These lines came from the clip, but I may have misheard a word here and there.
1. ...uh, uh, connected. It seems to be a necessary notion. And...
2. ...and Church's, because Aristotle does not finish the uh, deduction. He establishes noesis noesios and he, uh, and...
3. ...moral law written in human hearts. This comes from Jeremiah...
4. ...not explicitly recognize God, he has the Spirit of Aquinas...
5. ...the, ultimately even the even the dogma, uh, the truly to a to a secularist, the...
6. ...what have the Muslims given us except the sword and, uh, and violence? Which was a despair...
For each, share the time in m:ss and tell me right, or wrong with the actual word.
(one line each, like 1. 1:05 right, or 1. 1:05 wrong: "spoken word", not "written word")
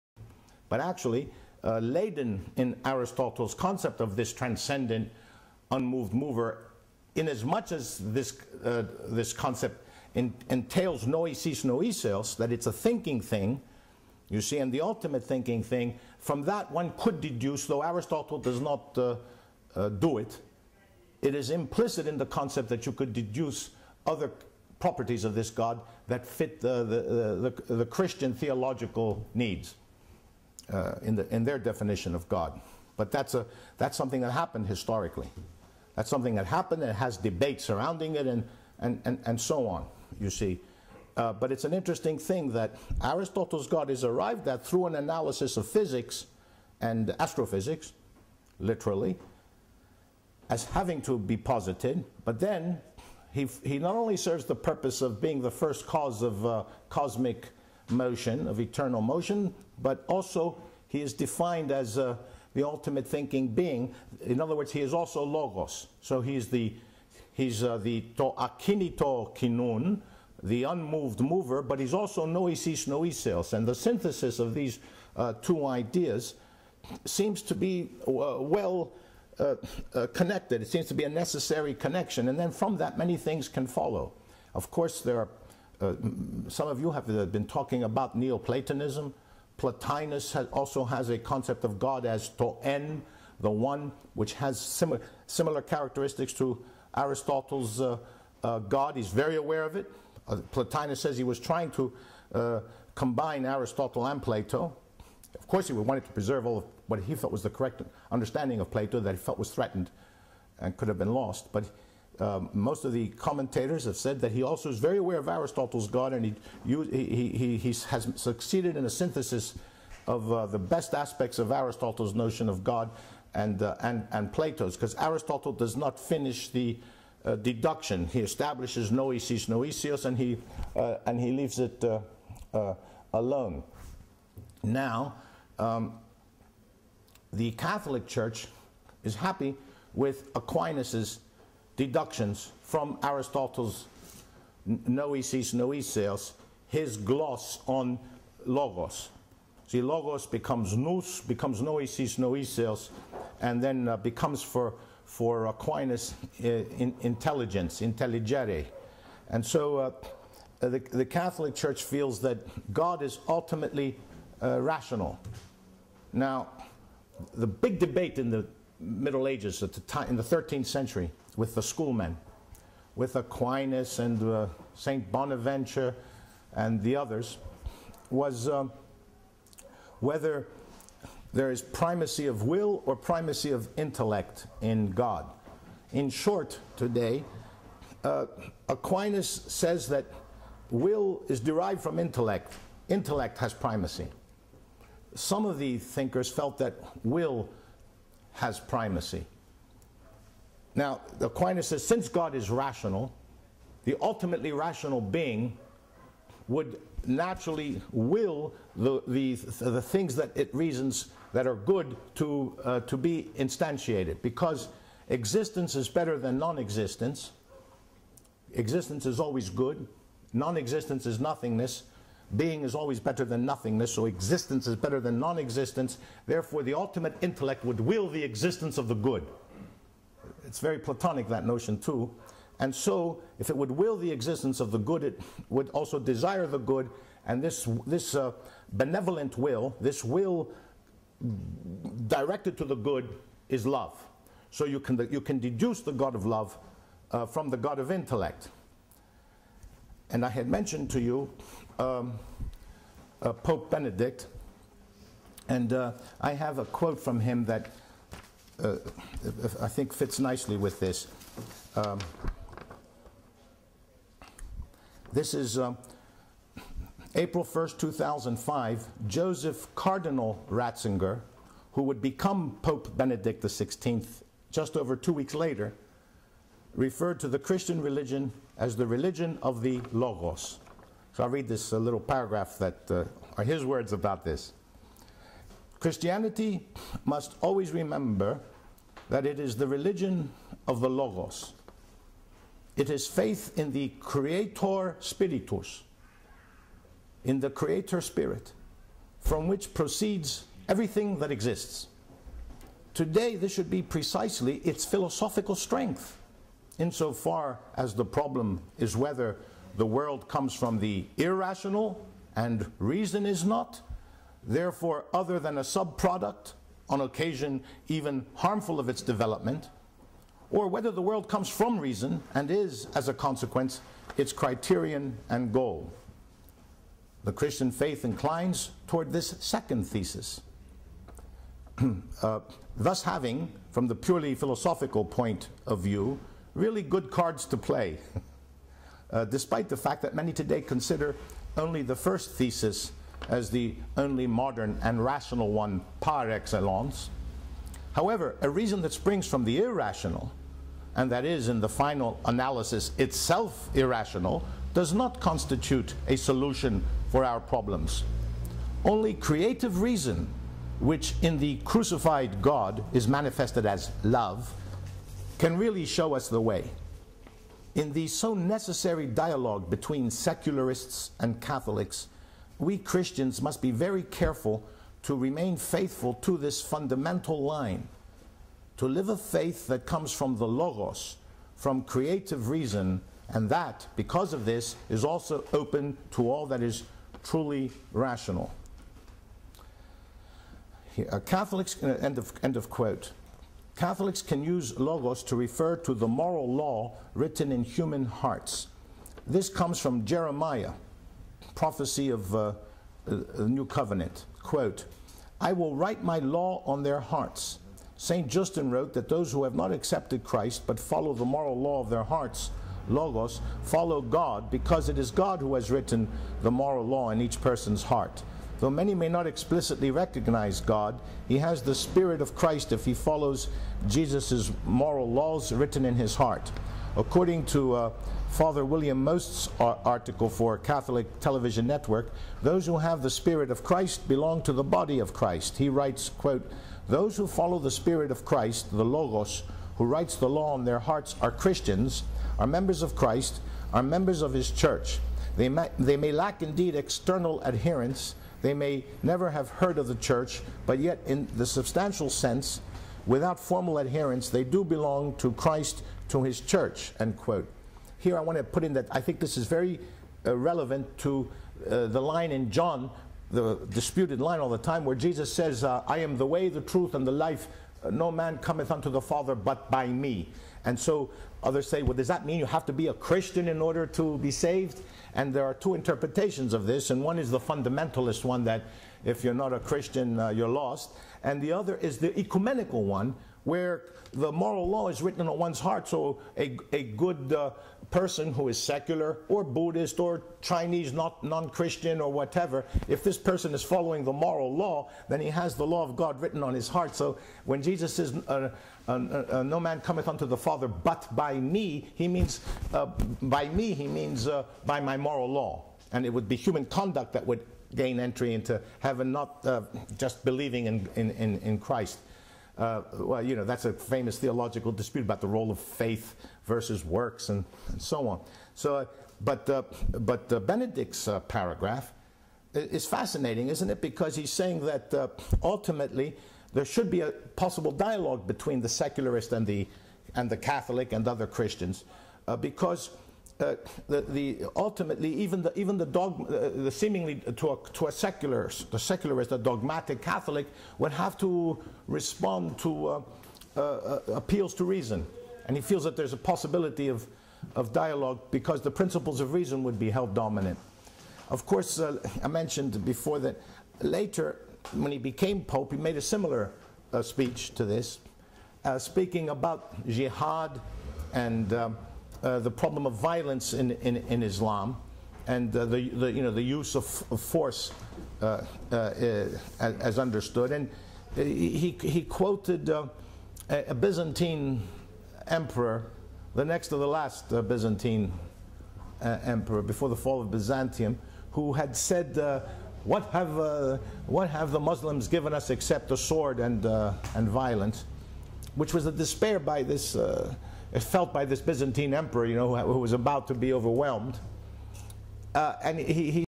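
1. 1:19 wrong: "connection", not "notion"
2. 2:04 wrong: "Plato", not "Church"
3. 6:36 right
4. 6:59 wrong: "Christ", not "Aquinas"
5. 8:54 wrong: "seemingly", not "truly"
6. 9:44 right.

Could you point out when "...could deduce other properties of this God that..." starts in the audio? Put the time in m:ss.
0:22.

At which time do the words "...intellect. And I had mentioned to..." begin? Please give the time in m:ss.
4:07.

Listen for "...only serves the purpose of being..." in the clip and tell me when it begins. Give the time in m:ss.
0:53.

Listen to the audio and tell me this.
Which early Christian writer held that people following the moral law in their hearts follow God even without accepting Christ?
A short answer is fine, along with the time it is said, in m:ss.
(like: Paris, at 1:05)
St. Justin, at 6:47.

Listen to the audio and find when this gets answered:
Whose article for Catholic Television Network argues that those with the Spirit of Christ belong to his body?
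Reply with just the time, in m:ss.
7:08.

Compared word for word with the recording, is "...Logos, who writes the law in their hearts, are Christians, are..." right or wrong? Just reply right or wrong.
right.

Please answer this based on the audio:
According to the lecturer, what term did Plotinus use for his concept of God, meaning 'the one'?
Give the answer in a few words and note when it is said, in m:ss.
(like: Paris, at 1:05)
to en, at 1:32.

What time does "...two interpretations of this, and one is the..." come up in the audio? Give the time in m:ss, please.
7:55.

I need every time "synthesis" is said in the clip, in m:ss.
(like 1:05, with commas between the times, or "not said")
1:13, 1:58.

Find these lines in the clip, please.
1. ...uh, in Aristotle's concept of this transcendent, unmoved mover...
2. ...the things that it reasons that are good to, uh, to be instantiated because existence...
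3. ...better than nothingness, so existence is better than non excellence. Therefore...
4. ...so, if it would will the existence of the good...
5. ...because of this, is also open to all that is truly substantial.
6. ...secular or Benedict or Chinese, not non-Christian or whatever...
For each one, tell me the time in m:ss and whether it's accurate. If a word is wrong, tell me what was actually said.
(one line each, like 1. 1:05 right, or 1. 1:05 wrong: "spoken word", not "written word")
1. 0:01 right
2. 3:29 right
3. 3:42 wrong: "existence", not "excellence"
4. 3:52 right
5. 6:23 wrong: "rational", not "substantial"
6. 8:08 wrong: "Buddhist", not "Benedict".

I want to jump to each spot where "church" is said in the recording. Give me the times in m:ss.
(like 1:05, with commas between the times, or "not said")
2:18, 2:41, 7:24, 7:29, 7:36.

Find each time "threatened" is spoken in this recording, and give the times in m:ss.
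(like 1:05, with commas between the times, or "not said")
1:49.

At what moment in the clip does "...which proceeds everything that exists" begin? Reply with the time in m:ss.
4:59.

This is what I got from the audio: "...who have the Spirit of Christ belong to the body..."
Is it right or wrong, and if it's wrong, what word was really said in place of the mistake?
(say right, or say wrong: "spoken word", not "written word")
right.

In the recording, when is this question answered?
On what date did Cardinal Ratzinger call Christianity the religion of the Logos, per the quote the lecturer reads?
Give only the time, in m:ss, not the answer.
4:27.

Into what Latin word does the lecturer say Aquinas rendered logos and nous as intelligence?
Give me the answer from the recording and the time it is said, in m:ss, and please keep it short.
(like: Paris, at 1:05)
intelligere, at 2:37.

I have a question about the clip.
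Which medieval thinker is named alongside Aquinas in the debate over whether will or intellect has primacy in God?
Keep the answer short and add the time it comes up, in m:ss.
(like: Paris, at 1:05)
St. Bonaventure, at 2:54.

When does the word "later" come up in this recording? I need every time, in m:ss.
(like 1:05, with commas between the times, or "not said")
4:35, 9:13.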